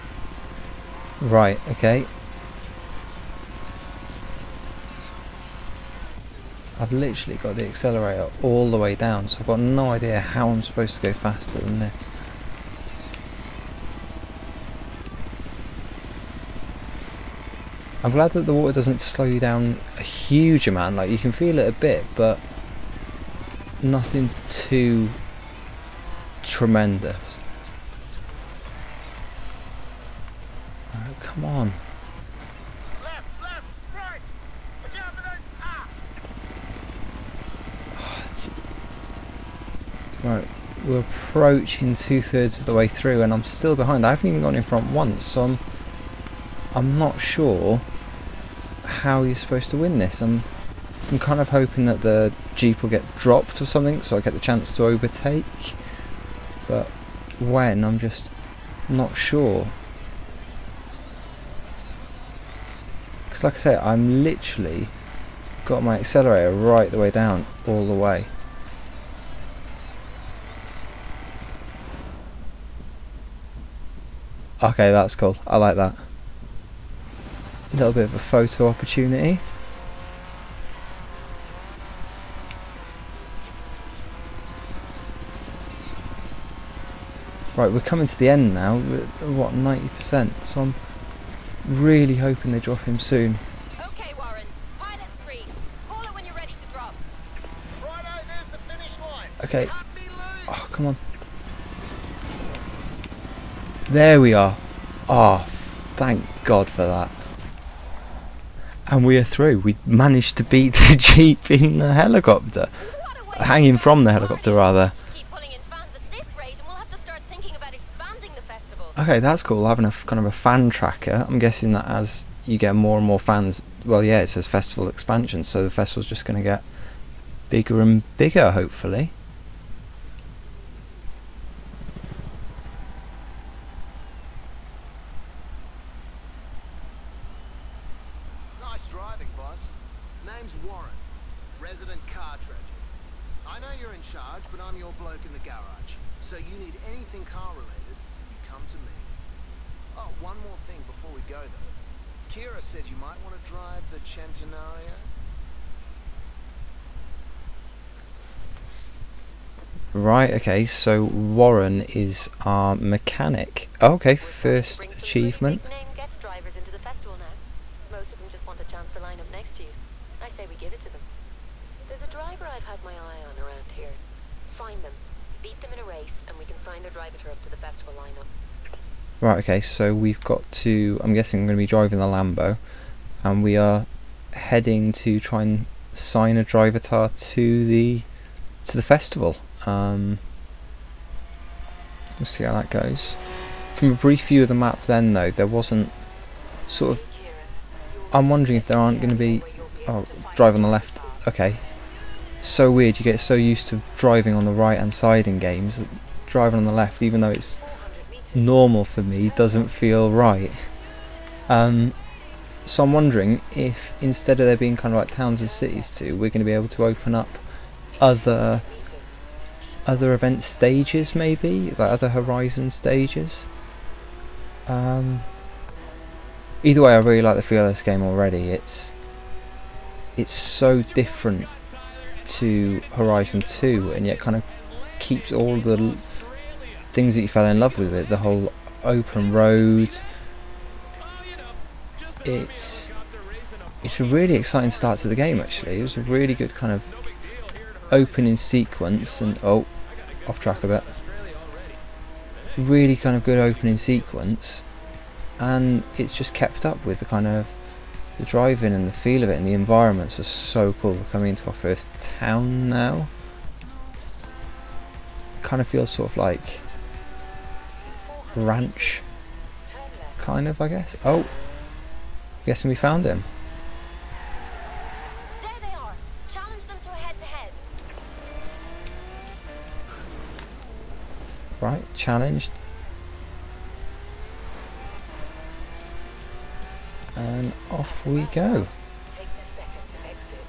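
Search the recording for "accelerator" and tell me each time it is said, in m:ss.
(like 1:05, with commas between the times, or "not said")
0:07, 1:05.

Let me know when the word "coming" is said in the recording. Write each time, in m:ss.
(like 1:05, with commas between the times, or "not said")
1:27, 4:21.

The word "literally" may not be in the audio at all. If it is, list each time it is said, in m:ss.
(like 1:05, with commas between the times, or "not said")
0:06, 1:04.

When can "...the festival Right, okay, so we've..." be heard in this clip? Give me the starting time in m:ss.
2:57.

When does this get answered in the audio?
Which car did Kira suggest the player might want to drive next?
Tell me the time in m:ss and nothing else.
2:33.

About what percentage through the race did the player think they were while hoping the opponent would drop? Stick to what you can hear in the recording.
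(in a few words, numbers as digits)
90%.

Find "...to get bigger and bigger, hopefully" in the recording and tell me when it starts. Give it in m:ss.
2:06.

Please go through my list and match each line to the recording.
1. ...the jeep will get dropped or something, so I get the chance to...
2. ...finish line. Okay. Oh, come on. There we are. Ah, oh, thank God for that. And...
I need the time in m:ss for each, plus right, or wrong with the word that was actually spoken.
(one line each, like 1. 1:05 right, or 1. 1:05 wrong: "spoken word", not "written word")
1. 0:52 right
2. 1:38 right.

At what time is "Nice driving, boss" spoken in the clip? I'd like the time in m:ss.
2:18.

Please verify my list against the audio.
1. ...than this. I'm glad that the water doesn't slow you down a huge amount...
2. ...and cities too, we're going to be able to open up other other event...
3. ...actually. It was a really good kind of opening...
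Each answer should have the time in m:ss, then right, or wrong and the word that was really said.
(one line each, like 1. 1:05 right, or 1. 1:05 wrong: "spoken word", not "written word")
1. 0:11 right
2. 3:35 right
3. 4:05 right.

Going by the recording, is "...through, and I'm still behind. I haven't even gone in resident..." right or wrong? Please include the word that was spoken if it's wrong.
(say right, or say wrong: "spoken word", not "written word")
wrong: "front", not "resident".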